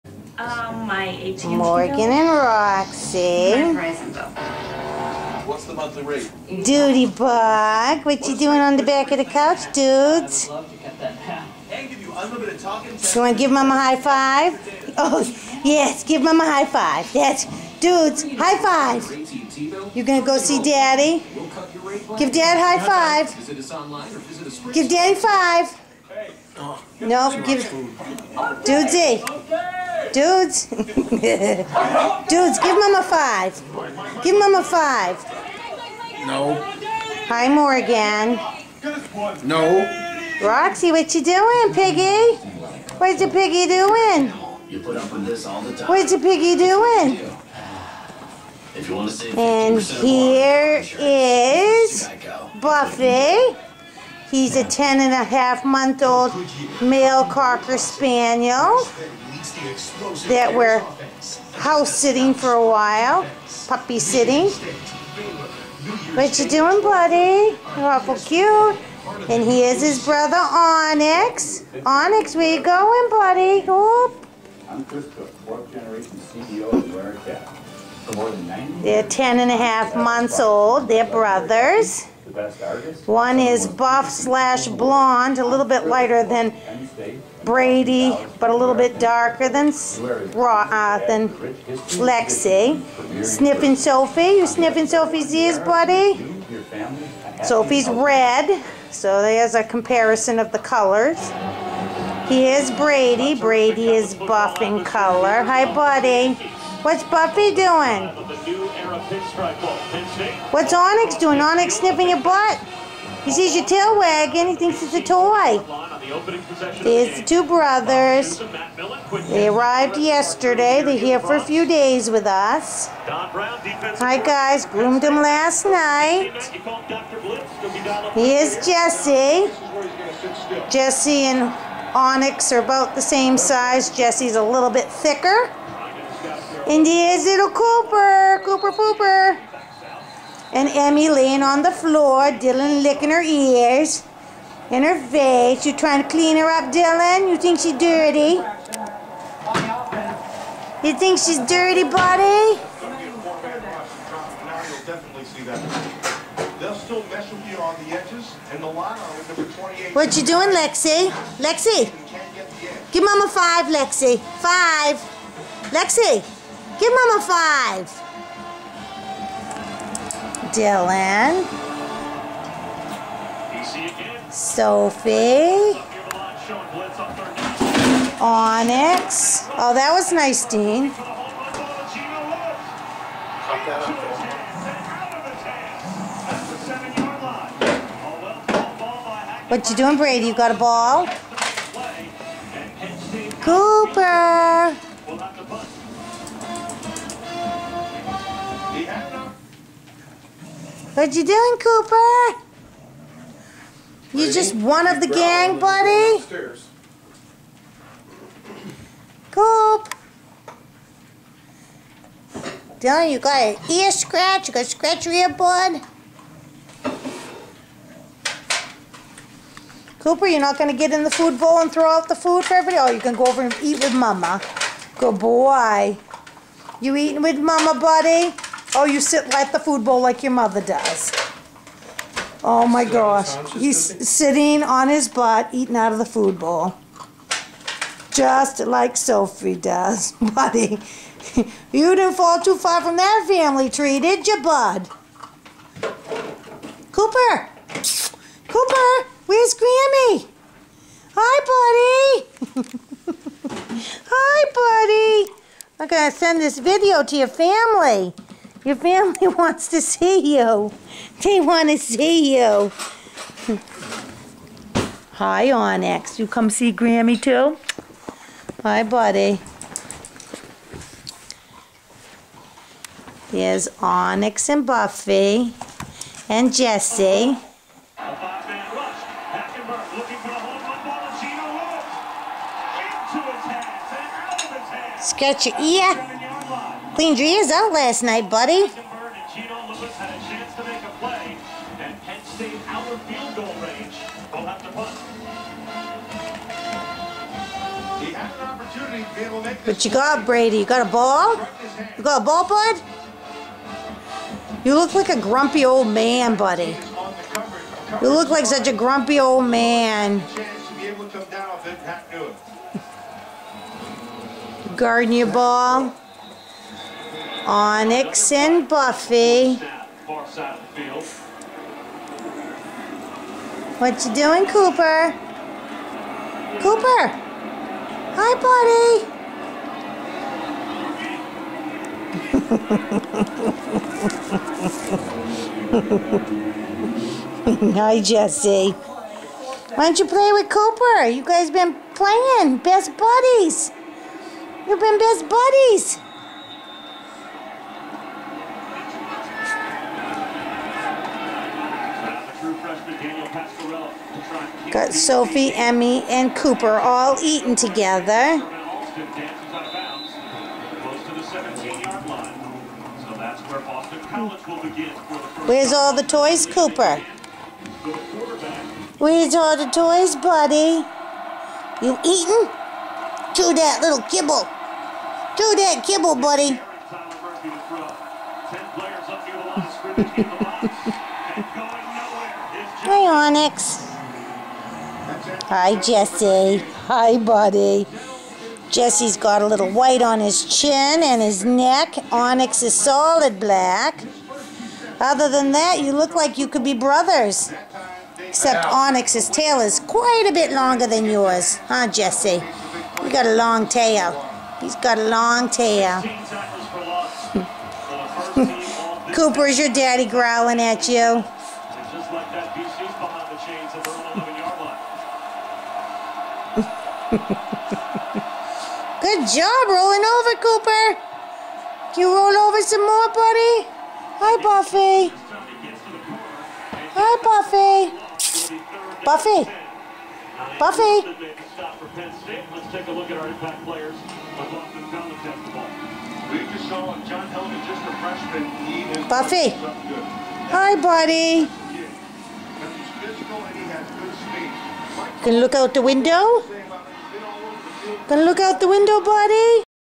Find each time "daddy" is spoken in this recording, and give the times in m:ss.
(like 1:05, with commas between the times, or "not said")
0:20, 0:24, 6:49.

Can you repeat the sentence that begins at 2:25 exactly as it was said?
You trying to clean her up, Dylan?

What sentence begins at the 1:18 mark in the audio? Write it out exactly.
They're 10 and a half months old.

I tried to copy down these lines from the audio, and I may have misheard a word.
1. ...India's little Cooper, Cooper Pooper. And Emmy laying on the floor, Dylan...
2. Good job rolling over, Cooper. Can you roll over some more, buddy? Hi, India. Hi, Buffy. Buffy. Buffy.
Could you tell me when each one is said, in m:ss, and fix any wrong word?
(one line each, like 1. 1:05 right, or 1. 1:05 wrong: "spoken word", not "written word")
1. 2:16 right
2. 6:57 wrong: "Buffy", not "India".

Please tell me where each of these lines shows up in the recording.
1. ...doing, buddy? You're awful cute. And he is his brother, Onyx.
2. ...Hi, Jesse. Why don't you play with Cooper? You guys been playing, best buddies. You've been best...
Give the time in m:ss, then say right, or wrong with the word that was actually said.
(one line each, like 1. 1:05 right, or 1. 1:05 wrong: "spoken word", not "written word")
1. 1:06 right
2. 5:37 right.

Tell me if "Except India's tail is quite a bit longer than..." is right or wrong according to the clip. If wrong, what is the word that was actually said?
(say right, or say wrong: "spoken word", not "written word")
wrong: "Onyx", not "India".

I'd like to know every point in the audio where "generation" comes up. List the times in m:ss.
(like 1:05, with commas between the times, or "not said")
1:15.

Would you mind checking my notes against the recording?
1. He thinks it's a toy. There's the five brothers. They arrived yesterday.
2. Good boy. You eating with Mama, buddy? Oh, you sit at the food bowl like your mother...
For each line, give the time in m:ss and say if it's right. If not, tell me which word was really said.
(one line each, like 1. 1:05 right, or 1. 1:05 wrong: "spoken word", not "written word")
1. 1:54 wrong: "two", not "five"
2. 3:44 right.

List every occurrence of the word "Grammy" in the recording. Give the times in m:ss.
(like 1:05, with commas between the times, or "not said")
4:09, 4:26.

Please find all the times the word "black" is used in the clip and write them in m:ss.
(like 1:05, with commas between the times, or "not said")
6:33.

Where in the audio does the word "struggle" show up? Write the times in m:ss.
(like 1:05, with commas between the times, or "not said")
not said.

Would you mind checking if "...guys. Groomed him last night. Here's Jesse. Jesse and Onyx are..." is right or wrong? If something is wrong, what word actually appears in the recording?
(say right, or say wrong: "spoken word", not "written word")
right.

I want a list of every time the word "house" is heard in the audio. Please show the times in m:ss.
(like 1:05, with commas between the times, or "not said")
1:01.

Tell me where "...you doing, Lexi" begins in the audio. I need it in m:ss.
2:40.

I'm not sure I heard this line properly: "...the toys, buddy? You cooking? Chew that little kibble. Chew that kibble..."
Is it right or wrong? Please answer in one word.
wrong.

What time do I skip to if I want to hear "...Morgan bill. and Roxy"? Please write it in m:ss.
0:01.